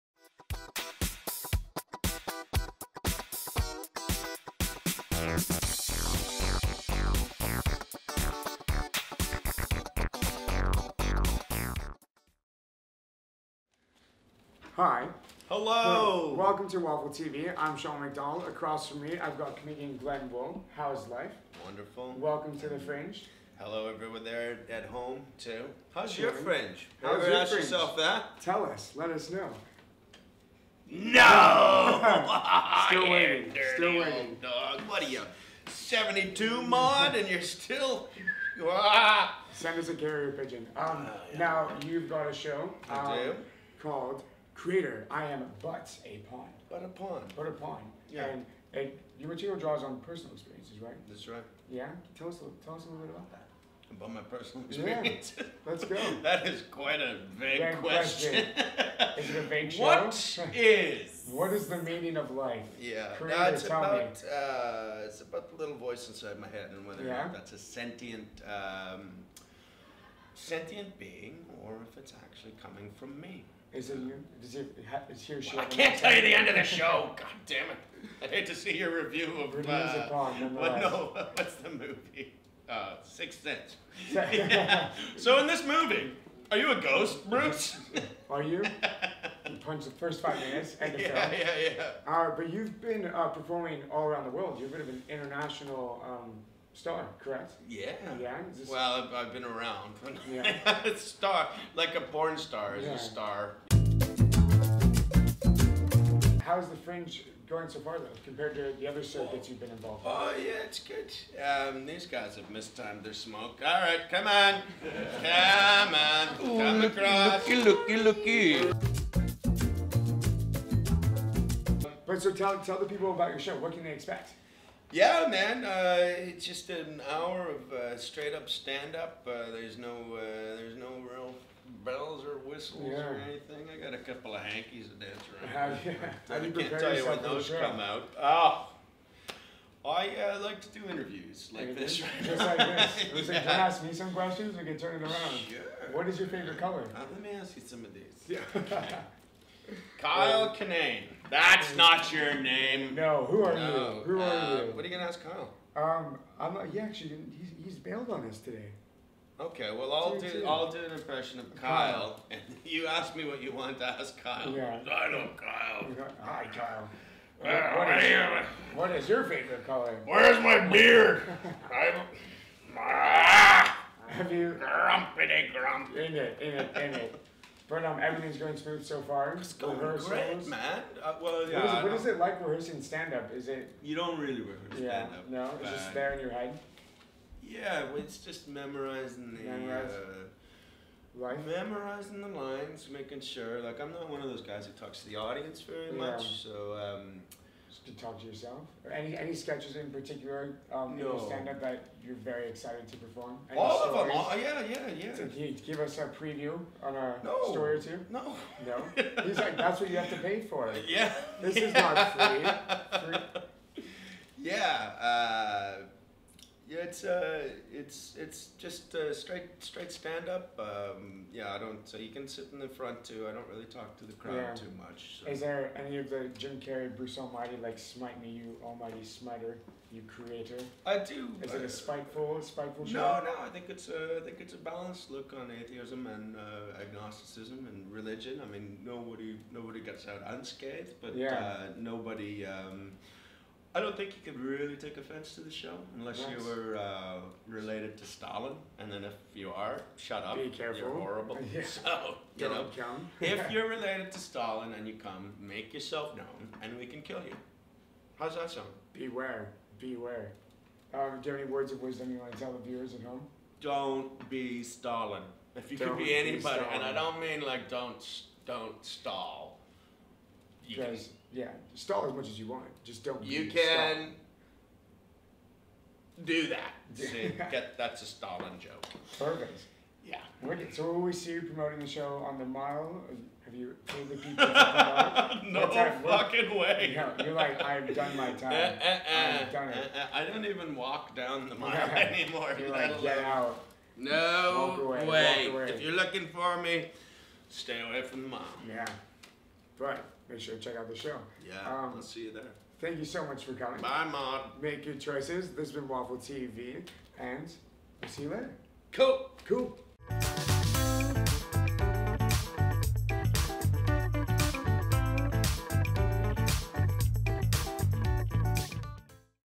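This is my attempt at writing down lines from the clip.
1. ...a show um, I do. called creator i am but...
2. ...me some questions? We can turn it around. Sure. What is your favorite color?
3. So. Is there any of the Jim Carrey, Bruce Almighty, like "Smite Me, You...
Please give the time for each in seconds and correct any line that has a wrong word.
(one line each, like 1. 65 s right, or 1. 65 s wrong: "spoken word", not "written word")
1. 42 s right
2. 143 s right
3. 225 s right.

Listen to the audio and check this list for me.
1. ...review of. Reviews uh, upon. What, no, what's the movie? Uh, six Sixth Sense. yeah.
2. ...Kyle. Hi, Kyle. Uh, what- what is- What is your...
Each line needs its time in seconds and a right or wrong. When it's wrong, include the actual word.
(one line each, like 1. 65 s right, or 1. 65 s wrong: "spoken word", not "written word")
1. 79 s right
2. 165 s right.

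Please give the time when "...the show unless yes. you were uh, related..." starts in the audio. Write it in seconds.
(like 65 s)
245 s.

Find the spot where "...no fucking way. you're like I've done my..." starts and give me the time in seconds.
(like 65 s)
285 s.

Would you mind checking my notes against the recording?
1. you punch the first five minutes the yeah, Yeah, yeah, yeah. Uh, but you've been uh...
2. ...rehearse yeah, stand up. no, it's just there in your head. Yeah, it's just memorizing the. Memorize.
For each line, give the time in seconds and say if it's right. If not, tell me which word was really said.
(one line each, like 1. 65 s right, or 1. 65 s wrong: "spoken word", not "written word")
1. 89 s right
2. 184 s right.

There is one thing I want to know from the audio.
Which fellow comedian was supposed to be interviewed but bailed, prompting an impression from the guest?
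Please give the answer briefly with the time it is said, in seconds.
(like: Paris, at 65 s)
Kyle Kinane, at 149 s.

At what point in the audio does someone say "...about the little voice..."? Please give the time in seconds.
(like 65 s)
65 s.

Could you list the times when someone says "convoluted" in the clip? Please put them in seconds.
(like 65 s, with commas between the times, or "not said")
not said.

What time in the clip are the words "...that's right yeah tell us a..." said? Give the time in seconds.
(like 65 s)
51 s.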